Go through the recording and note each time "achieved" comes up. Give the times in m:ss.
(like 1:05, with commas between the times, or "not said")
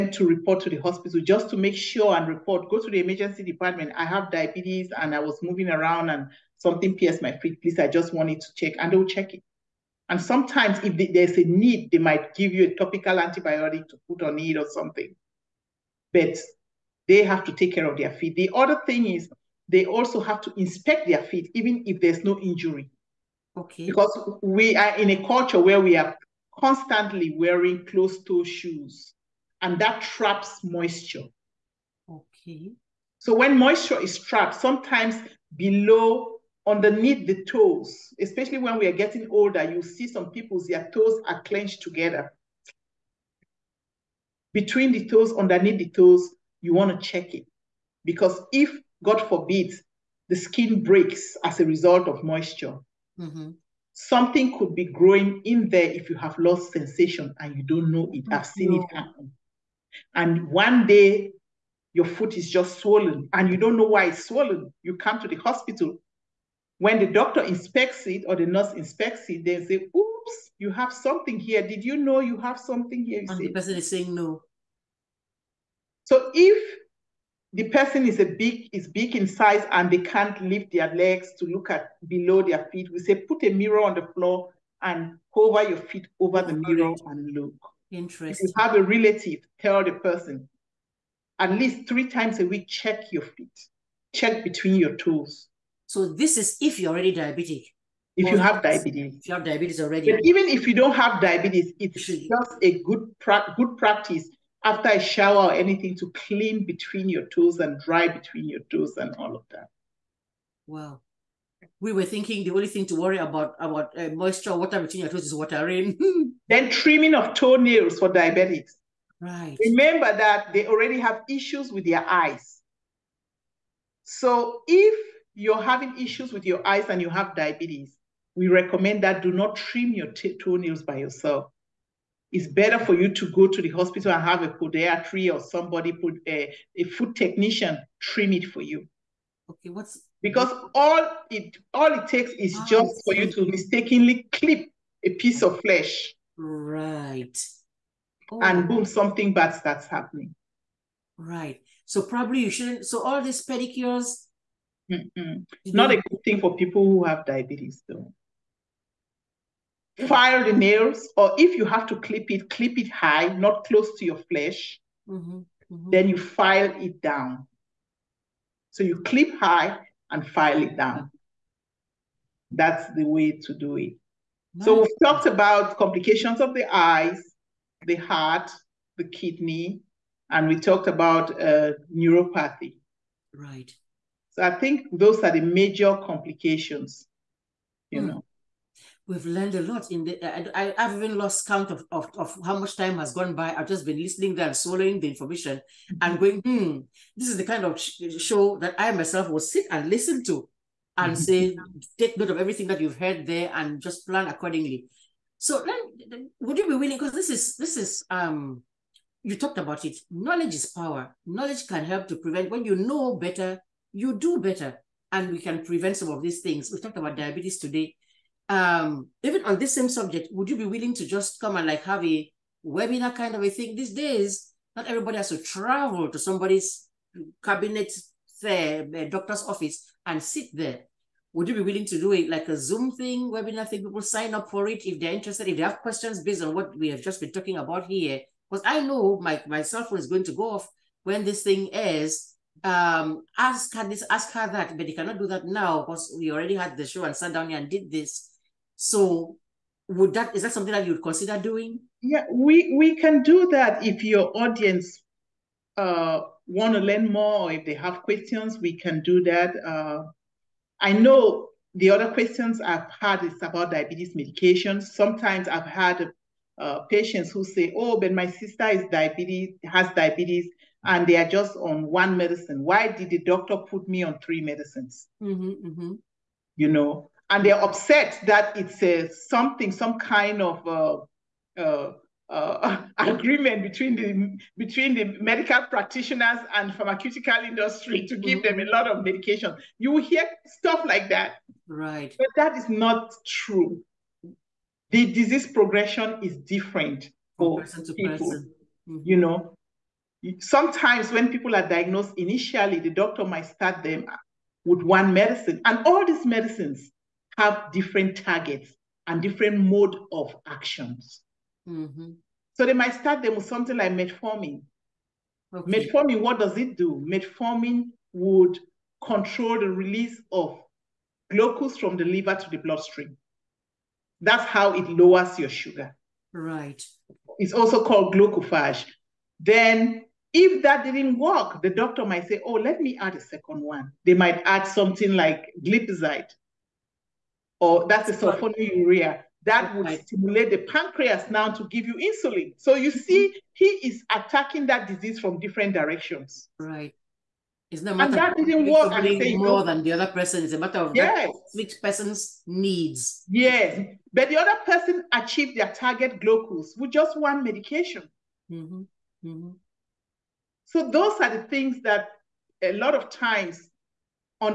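5:55.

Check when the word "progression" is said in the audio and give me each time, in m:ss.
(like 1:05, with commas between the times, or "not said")
4:55.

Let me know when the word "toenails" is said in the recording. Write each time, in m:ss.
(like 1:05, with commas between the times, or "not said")
1:57, 2:10.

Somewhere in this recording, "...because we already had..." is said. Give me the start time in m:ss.
4:05.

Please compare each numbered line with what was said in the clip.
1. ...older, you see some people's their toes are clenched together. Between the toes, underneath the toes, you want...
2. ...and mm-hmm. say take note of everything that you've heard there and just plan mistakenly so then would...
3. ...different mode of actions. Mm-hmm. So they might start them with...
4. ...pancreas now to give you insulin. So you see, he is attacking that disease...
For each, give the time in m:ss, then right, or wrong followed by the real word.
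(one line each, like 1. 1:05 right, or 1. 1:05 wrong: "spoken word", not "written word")
1. 0:39 right
2. 3:20 wrong: "accordingly", not "mistakenly"
3. 5:09 right
4. 5:40 right.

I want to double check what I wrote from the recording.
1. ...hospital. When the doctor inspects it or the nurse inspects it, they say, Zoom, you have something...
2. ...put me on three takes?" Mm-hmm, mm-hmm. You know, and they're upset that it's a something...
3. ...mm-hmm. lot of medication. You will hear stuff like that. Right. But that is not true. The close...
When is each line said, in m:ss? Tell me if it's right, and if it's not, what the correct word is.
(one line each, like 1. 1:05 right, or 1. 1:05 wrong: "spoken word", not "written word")
1. 1:05 wrong: "Oops", not "Zoom"
2. 4:33 wrong: "medicines", not "takes"
3. 4:48 wrong: "disease", not "close".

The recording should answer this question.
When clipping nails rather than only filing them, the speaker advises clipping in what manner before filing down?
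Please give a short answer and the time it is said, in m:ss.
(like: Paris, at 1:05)
Clip high, at 2:42.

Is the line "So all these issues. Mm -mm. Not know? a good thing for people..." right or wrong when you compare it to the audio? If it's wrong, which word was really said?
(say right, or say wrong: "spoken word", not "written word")
wrong: "pedicures", not "issues".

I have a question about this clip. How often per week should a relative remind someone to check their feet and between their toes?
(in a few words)
3 times.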